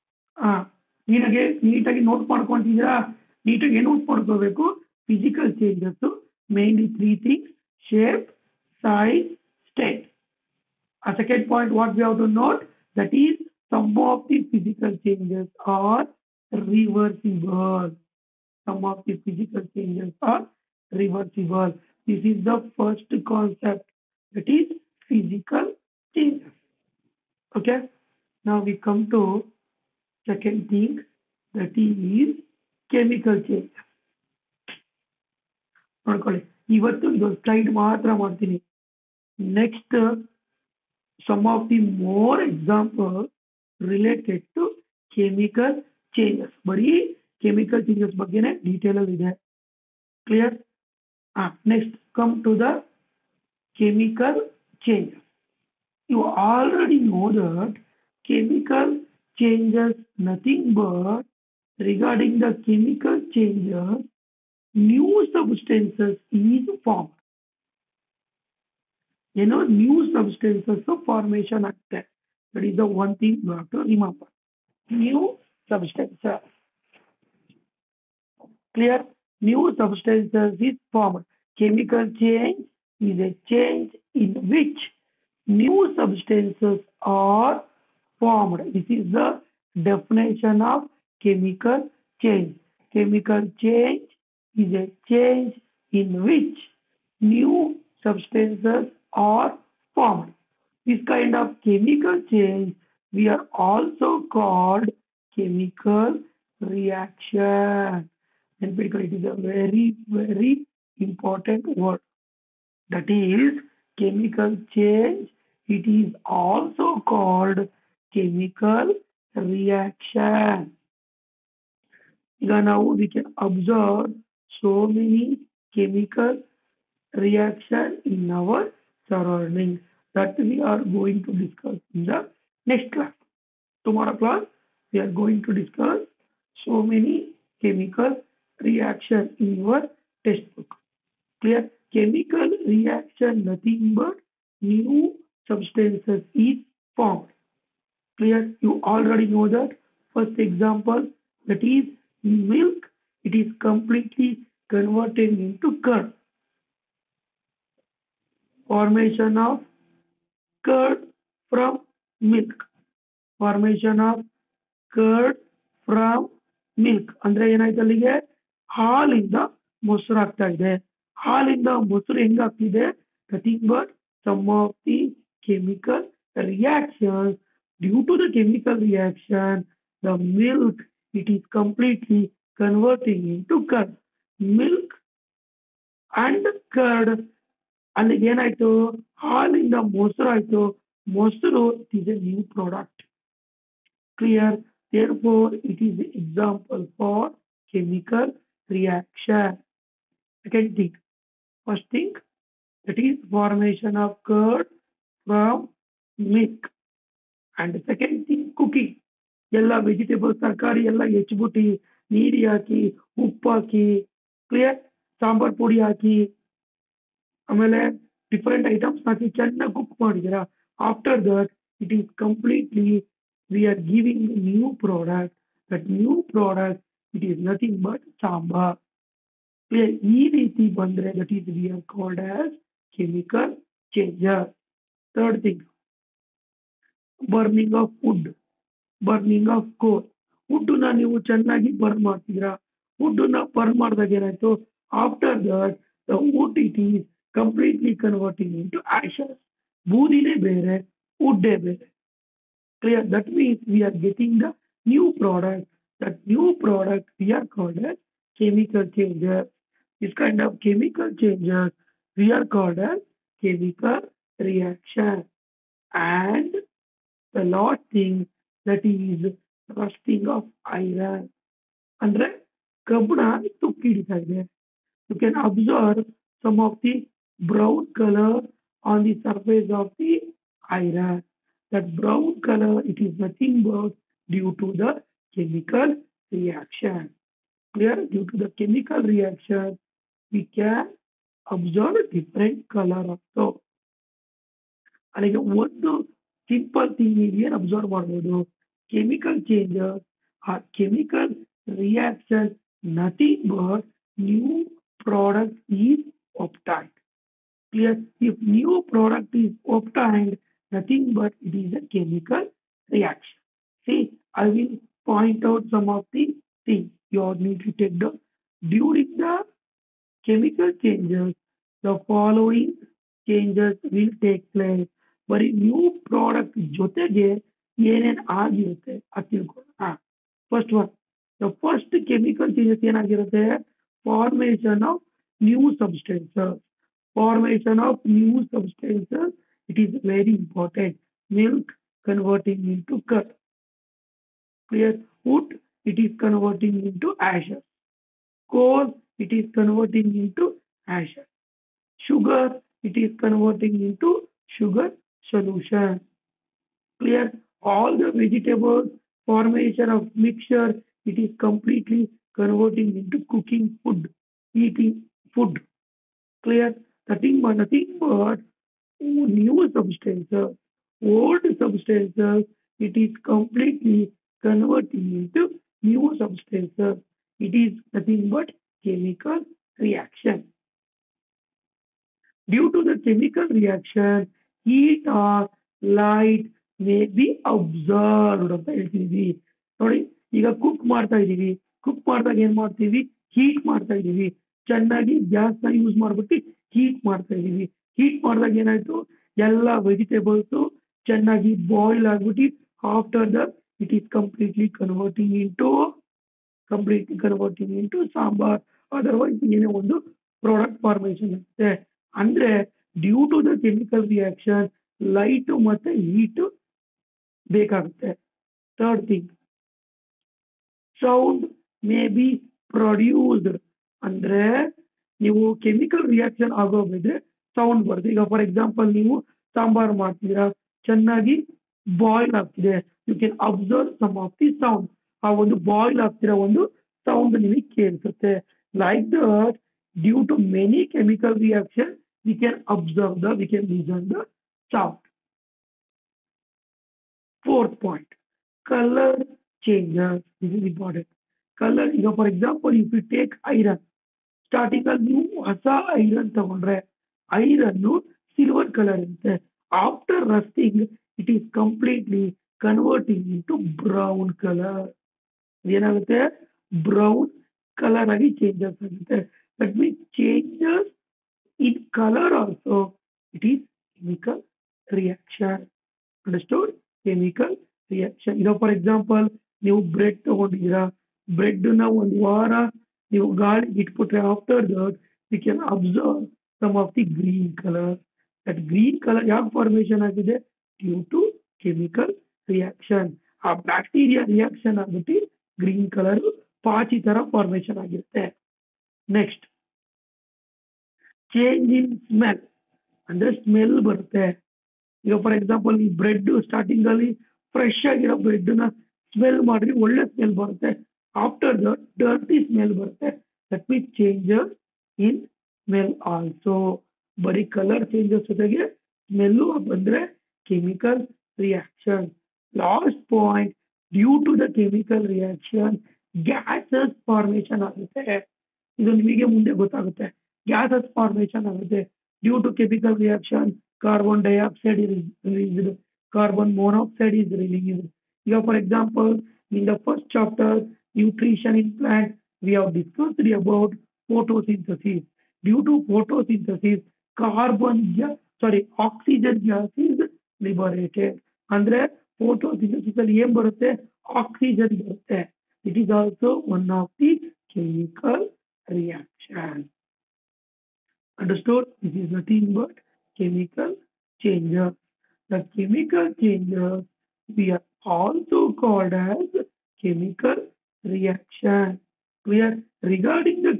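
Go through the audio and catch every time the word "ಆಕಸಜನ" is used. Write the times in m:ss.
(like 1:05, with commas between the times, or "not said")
9:08, 9:14.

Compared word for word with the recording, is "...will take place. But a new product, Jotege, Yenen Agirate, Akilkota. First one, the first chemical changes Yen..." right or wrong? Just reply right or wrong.
right.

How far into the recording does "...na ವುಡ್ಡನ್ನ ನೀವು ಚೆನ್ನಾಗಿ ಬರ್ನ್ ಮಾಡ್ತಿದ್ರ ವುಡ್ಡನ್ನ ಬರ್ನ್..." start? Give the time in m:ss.
4:00.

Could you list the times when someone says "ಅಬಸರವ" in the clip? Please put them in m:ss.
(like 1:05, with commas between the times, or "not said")
4:57, 7:13, 7:22, 8:05.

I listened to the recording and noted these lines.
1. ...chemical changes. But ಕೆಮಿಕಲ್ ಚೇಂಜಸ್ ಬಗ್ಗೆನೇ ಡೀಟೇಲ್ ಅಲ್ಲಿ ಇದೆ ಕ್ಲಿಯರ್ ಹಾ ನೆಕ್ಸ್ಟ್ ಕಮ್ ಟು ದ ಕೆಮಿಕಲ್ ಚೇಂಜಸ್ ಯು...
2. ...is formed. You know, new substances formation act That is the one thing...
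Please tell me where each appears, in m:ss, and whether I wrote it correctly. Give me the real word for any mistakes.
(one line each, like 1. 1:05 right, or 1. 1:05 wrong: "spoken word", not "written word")
1. 0:45 right
2. 1:06 right.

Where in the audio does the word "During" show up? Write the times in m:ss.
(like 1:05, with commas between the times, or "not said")
5:18.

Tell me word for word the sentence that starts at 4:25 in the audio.
And the last thing that is rusting of iron.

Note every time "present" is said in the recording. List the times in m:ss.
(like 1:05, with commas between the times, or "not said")
not said.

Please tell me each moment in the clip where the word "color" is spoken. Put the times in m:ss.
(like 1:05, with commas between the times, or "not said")
4:37, 4:42, 4:52, 7:31, 7:44.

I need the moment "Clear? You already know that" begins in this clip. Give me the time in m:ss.
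2:28.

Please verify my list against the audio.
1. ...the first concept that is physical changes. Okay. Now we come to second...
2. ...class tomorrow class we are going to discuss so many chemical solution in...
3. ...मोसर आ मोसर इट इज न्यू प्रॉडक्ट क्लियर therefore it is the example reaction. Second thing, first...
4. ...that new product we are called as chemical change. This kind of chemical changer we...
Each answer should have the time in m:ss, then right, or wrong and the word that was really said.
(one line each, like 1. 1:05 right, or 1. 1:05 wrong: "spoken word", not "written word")
1. 0:22 right
2. 2:12 wrong: "reaction", not "solution"
3. 3:09 right
4. 4:16 right.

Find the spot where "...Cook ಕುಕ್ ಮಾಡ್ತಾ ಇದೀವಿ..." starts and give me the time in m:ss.
6:30.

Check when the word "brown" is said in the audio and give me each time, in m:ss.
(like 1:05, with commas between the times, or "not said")
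4:37, 4:41, 7:43.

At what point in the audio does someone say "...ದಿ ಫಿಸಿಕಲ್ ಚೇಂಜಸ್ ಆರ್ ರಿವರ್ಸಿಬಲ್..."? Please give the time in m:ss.
0:14.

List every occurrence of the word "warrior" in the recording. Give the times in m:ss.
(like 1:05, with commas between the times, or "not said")
not said.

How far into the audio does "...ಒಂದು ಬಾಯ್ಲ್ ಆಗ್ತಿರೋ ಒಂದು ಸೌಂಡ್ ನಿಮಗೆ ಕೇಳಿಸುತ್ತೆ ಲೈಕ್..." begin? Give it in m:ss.
7:15.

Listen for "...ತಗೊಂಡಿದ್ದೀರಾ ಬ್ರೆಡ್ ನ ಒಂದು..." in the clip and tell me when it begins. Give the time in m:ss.
8:00.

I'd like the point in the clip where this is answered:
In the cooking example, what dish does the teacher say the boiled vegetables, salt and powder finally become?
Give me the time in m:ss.
6:46.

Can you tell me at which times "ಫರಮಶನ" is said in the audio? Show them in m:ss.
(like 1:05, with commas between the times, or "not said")
6:50, 8:09, 8:17.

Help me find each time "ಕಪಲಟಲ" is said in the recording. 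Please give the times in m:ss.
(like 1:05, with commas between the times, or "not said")
3:42, 4:07.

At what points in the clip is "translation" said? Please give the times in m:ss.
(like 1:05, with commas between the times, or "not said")
not said.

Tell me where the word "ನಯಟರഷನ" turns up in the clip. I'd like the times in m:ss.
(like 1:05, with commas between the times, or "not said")
9:01.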